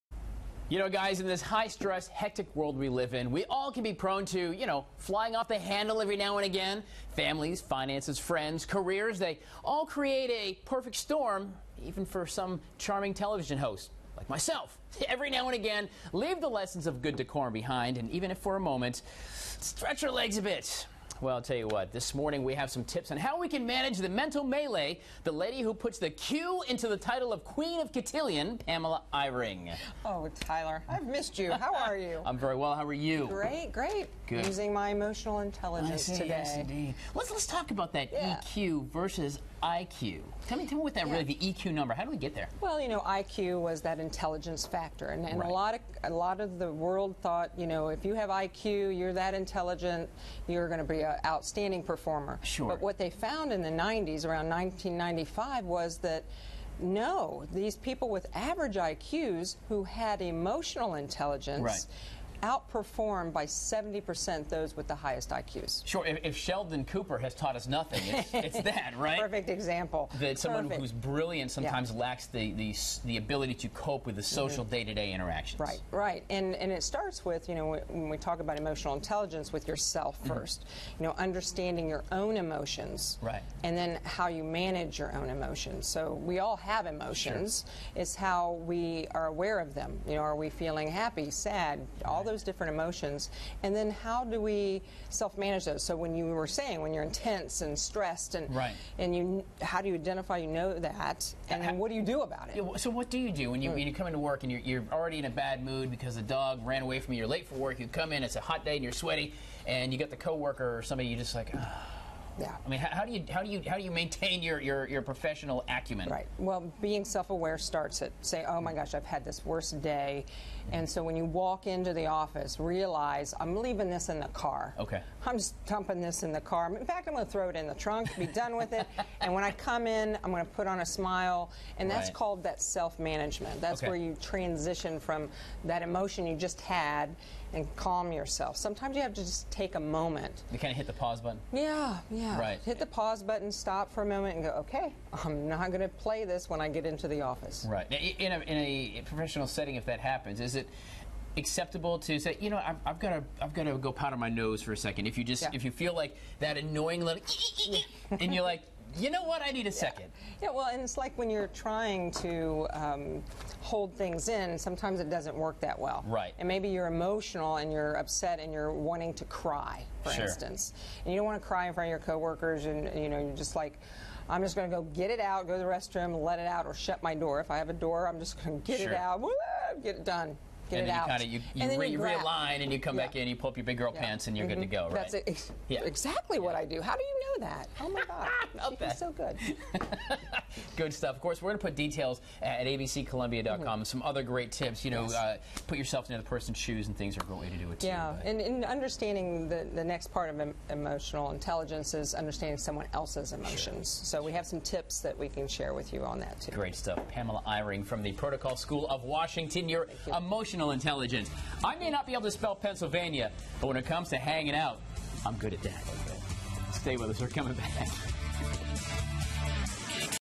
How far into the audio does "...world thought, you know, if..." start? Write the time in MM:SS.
00:46.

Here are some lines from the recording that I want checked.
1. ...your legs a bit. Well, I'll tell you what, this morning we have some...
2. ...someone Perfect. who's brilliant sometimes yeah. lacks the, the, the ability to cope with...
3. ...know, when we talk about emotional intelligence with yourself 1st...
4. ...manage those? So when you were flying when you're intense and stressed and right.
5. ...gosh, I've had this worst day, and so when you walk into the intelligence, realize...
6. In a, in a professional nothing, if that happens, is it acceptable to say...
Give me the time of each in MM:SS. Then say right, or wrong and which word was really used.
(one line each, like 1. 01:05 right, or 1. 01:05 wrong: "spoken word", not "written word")
1. 00:20 right
2. 01:10 right
3. 01:17 right
4. 01:35 wrong: "saying", not "flying"
5. 01:58 wrong: "office", not "intelligence"
6. 02:28 wrong: "setting", not "nothing".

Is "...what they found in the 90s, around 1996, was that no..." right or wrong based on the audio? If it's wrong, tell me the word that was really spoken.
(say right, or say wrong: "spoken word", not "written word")
wrong: "1995", not "1996".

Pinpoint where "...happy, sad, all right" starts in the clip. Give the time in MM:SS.
01:31.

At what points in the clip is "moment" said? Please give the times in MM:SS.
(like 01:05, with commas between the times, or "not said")
00:18, 02:19, 02:24.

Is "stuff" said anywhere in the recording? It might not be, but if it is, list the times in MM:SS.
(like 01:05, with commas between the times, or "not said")
03:10, 03:26.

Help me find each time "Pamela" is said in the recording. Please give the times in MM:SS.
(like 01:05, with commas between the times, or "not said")
00:28, 03:27.